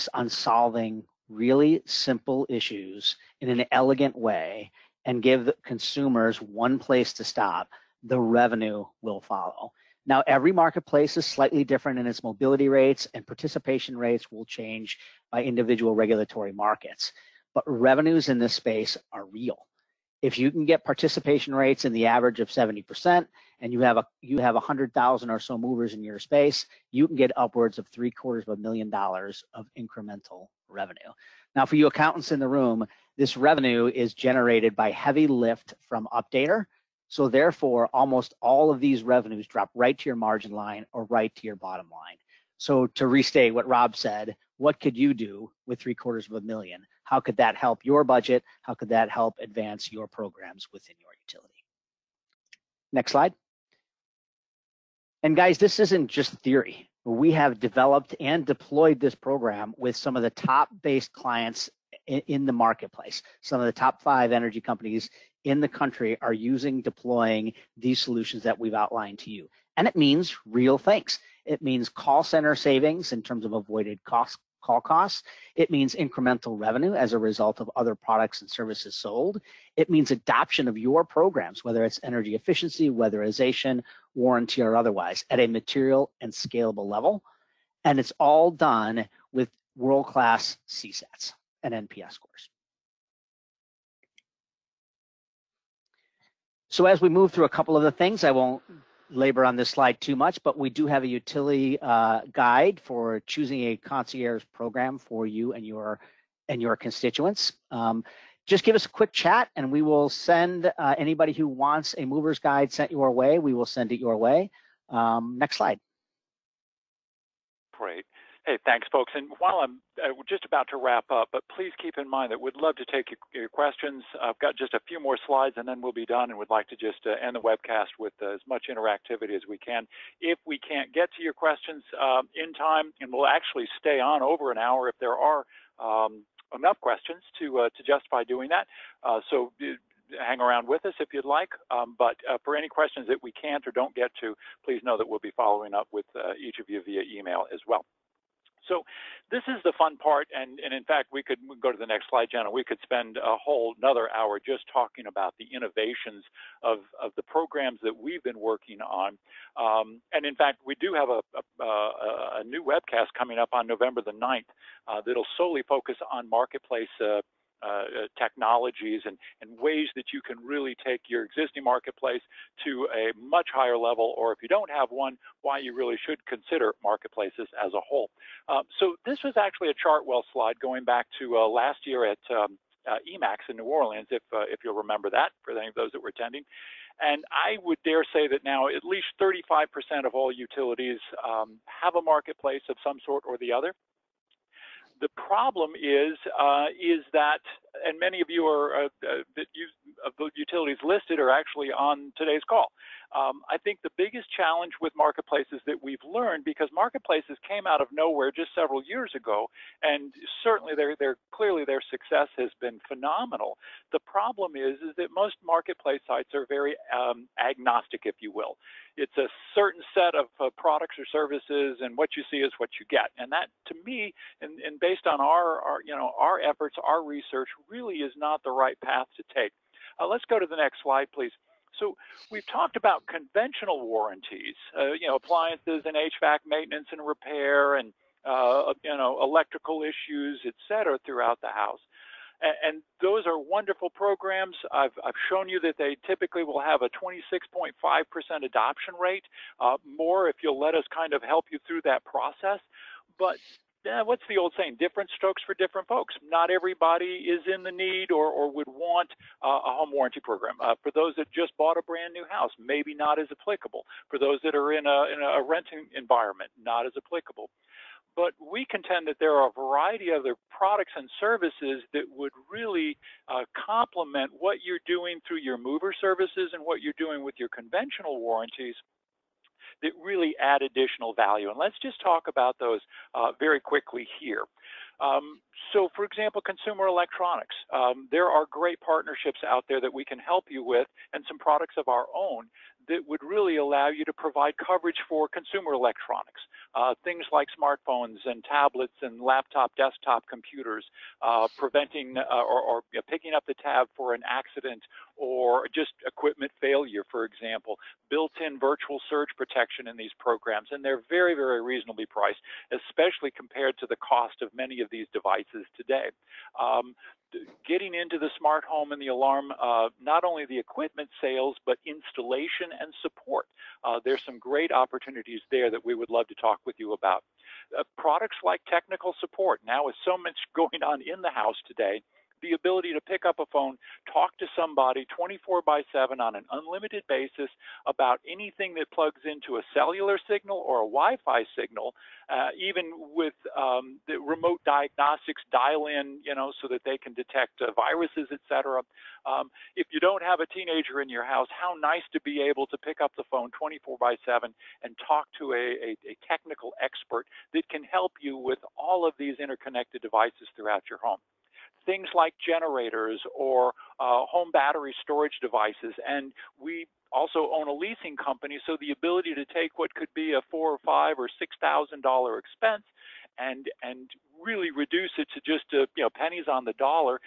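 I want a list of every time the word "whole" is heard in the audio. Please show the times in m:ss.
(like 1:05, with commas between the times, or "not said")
2:33, 2:57.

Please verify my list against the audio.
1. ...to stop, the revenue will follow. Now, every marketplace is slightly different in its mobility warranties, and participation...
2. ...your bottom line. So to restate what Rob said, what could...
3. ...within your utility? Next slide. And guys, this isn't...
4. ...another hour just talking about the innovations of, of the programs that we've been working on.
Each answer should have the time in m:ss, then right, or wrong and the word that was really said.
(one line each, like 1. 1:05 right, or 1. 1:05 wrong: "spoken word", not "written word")
1. 0:07 wrong: "rates", not "warranties"
2. 0:41 right
3. 0:50 right
4. 2:33 right.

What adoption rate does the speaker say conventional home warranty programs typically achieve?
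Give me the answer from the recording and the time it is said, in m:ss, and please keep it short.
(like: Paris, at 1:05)
26.5%, at 4:06.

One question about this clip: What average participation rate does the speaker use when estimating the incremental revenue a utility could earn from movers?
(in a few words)
70%.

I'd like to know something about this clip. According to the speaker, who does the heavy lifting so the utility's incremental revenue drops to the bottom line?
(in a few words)
Updater.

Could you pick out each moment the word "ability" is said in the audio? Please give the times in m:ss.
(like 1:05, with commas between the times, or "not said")
5:32, 6:08.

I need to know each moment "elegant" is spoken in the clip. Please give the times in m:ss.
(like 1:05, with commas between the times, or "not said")
0:03.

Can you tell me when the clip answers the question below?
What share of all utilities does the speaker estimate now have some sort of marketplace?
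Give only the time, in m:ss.
3:09.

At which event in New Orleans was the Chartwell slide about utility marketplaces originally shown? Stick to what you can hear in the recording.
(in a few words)
EMAX.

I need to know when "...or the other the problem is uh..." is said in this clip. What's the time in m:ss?
3:13.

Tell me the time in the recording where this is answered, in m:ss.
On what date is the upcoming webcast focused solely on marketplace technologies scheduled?
2:43.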